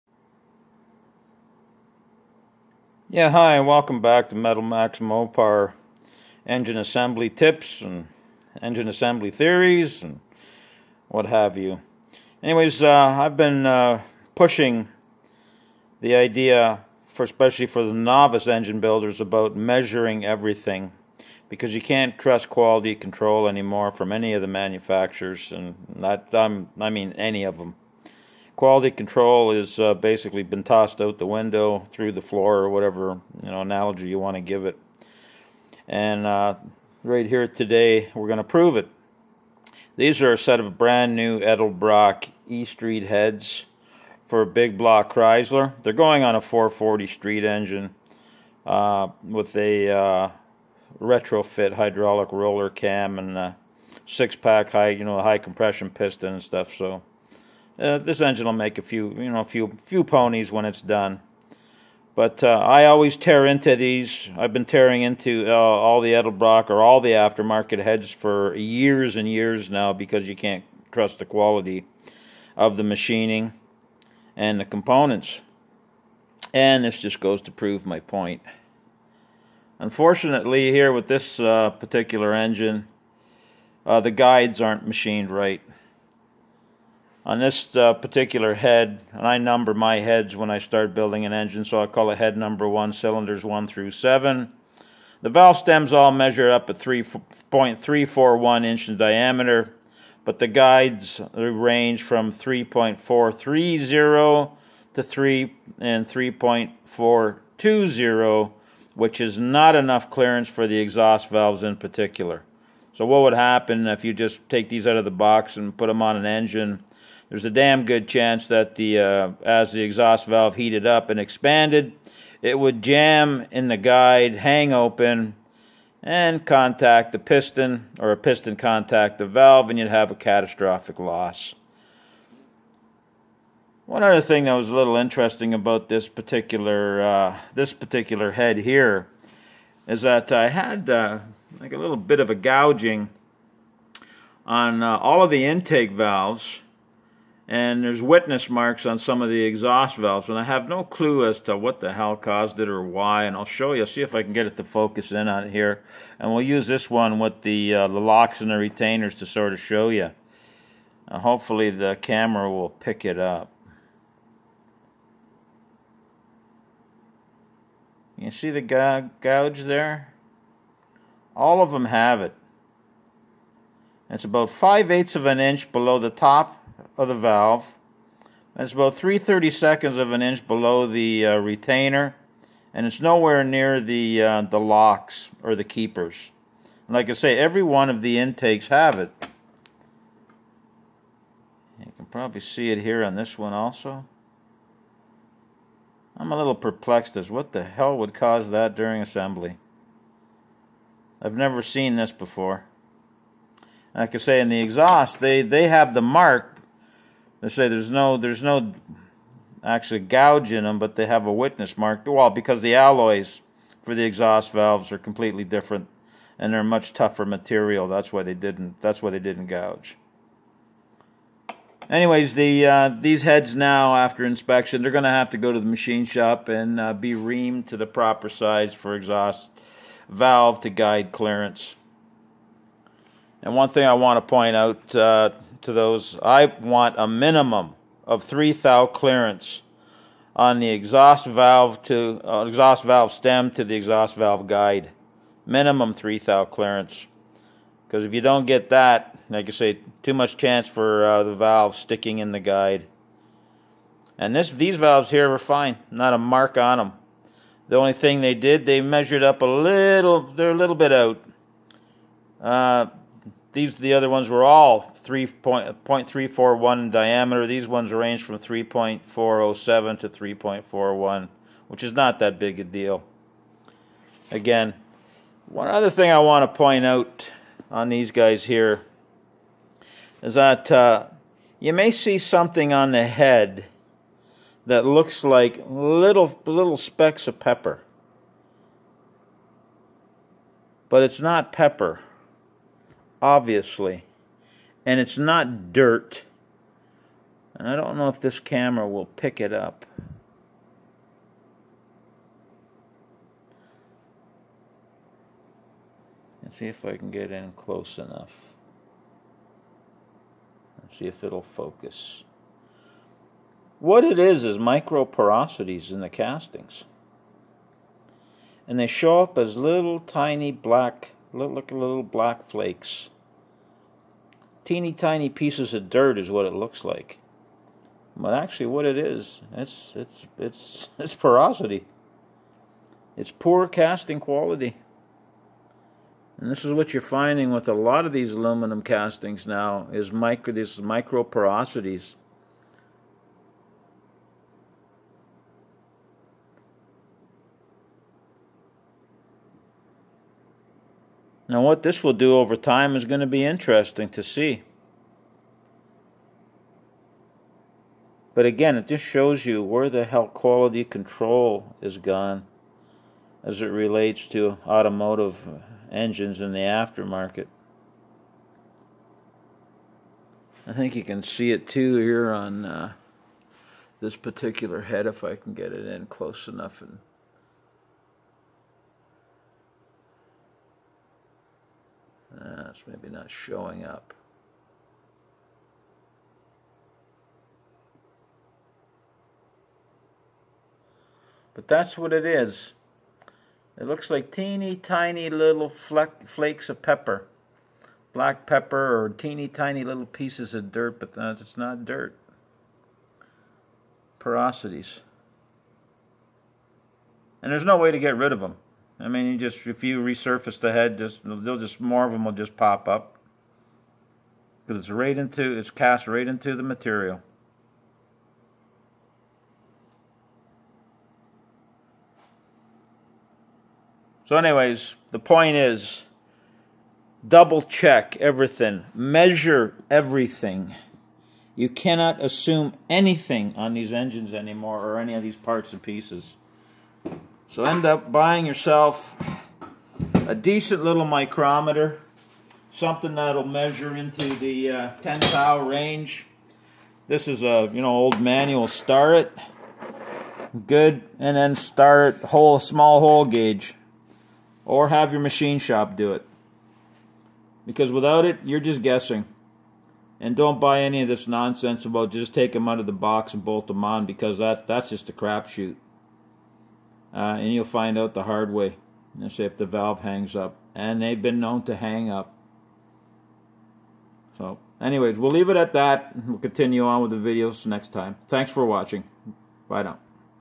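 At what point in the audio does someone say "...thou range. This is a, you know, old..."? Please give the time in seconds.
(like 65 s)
445 s.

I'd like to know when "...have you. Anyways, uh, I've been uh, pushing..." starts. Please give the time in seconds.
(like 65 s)
11 s.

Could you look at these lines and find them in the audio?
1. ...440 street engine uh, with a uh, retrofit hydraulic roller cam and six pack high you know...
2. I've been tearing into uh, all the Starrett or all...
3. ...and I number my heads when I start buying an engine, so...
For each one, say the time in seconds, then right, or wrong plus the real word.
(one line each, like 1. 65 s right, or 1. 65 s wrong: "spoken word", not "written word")
1. 46 s right
2. 64 s wrong: "Edelbrock", not "Starrett"
3. 89 s wrong: "building", not "buying".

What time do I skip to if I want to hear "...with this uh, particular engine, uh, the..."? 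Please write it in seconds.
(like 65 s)
80 s.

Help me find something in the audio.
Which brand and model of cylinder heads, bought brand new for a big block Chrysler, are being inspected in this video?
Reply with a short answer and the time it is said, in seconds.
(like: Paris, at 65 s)
Edelbrock E Street, at 41 s.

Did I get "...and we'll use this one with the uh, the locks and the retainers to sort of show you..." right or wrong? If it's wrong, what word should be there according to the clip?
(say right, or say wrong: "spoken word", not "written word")
right.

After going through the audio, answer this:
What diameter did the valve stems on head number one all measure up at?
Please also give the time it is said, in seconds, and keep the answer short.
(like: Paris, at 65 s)
3.341 inch, at 96 s.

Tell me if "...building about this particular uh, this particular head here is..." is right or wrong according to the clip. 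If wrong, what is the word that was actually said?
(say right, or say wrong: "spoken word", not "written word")
wrong: "interesting", not "building".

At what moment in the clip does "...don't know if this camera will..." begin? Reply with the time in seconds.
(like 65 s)
297 s.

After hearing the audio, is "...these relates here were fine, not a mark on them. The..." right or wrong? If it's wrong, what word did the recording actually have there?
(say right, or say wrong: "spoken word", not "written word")
wrong: "valves", not "relates".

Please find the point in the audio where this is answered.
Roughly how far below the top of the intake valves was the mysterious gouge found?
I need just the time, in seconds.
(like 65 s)
174 s.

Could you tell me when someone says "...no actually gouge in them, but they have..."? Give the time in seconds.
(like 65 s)
208 s.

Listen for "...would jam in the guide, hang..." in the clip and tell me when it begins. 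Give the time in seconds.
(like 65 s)
122 s.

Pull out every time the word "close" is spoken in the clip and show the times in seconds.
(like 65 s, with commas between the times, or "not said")
307 s, 376 s.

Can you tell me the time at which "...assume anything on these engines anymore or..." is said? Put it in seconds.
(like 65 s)
432 s.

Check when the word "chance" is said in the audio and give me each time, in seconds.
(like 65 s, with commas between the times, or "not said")
118 s, 250 s.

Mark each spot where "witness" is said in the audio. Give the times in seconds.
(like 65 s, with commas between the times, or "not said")
148 s, 211 s.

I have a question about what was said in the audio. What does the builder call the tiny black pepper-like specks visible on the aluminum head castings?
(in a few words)
microporosities.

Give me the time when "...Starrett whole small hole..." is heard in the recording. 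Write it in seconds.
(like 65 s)
451 s.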